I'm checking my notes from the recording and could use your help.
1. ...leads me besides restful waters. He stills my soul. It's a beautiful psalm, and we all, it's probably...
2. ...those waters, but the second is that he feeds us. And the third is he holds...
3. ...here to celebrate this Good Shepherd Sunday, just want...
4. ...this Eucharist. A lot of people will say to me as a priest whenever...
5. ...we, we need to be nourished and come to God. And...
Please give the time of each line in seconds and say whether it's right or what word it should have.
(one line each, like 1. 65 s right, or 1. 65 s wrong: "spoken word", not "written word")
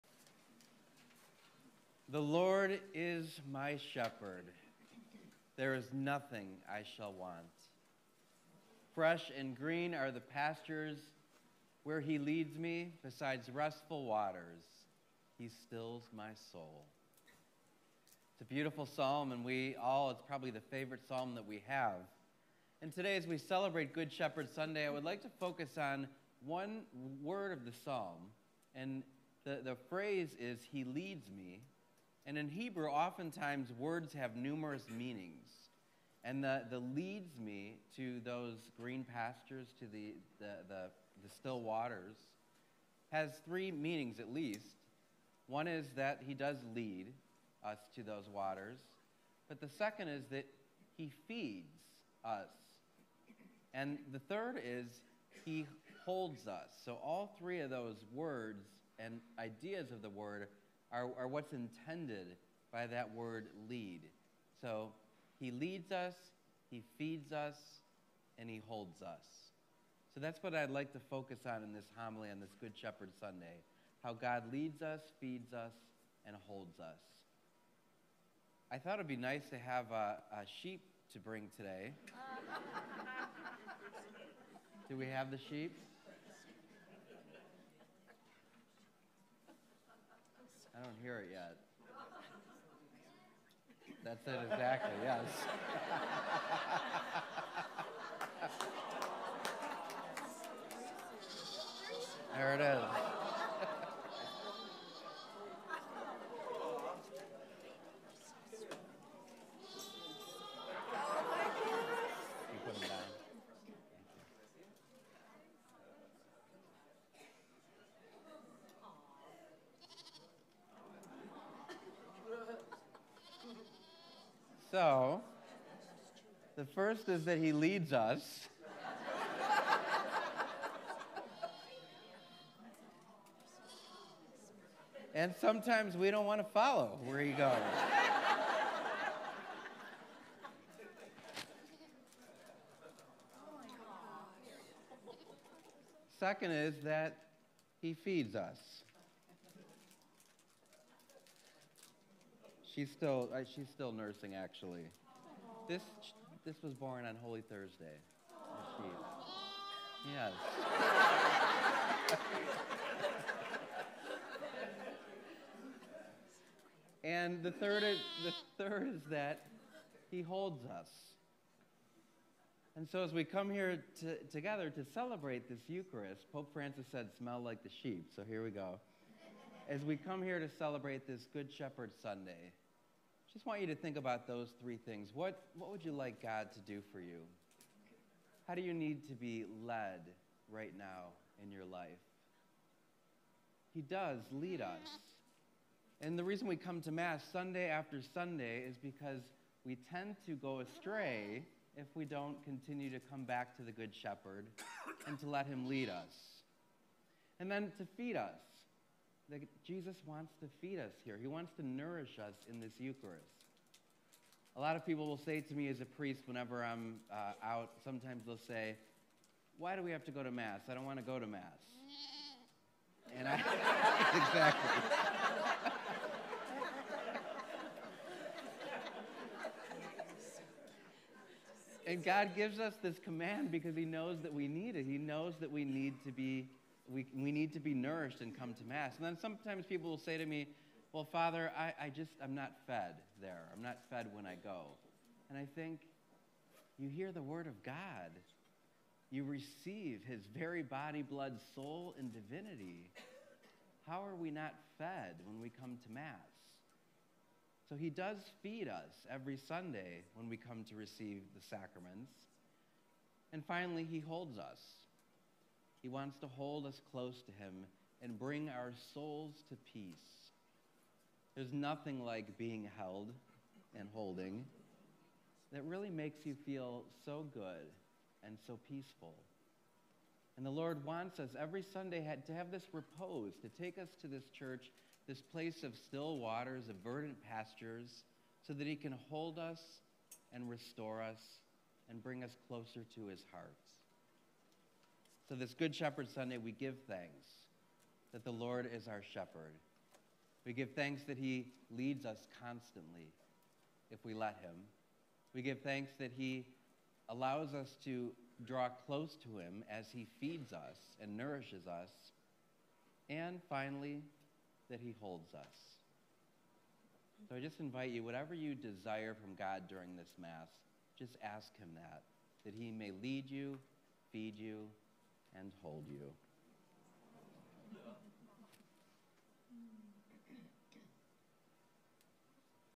1. 12 s right
2. 48 s right
3. 180 s right
4. 212 s right
5. 236 s wrong: "Mass", not "God".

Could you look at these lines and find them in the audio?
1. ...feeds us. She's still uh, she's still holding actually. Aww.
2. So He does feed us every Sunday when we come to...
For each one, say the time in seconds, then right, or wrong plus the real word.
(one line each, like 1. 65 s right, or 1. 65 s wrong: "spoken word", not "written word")
1. 147 s wrong: "nursing", not "holding"
2. 257 s right.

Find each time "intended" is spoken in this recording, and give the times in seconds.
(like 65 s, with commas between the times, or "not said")
61 s.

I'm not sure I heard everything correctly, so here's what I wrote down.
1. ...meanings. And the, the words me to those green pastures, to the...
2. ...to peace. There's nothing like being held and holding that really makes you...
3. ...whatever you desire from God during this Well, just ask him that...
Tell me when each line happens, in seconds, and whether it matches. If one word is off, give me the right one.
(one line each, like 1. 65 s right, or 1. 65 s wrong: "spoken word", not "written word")
1. 34 s wrong: "leads", not "words"
2. 269 s right
3. 318 s wrong: "Mass", not "Well".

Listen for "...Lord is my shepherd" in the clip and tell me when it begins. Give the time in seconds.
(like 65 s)
2 s.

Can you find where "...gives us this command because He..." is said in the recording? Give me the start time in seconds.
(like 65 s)
232 s.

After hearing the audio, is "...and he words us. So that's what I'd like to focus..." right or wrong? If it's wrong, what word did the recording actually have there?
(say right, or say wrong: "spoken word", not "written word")
wrong: "holds", not "words".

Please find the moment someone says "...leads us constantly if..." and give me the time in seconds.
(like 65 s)
301 s.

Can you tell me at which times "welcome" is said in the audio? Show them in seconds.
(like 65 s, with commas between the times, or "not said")
not said.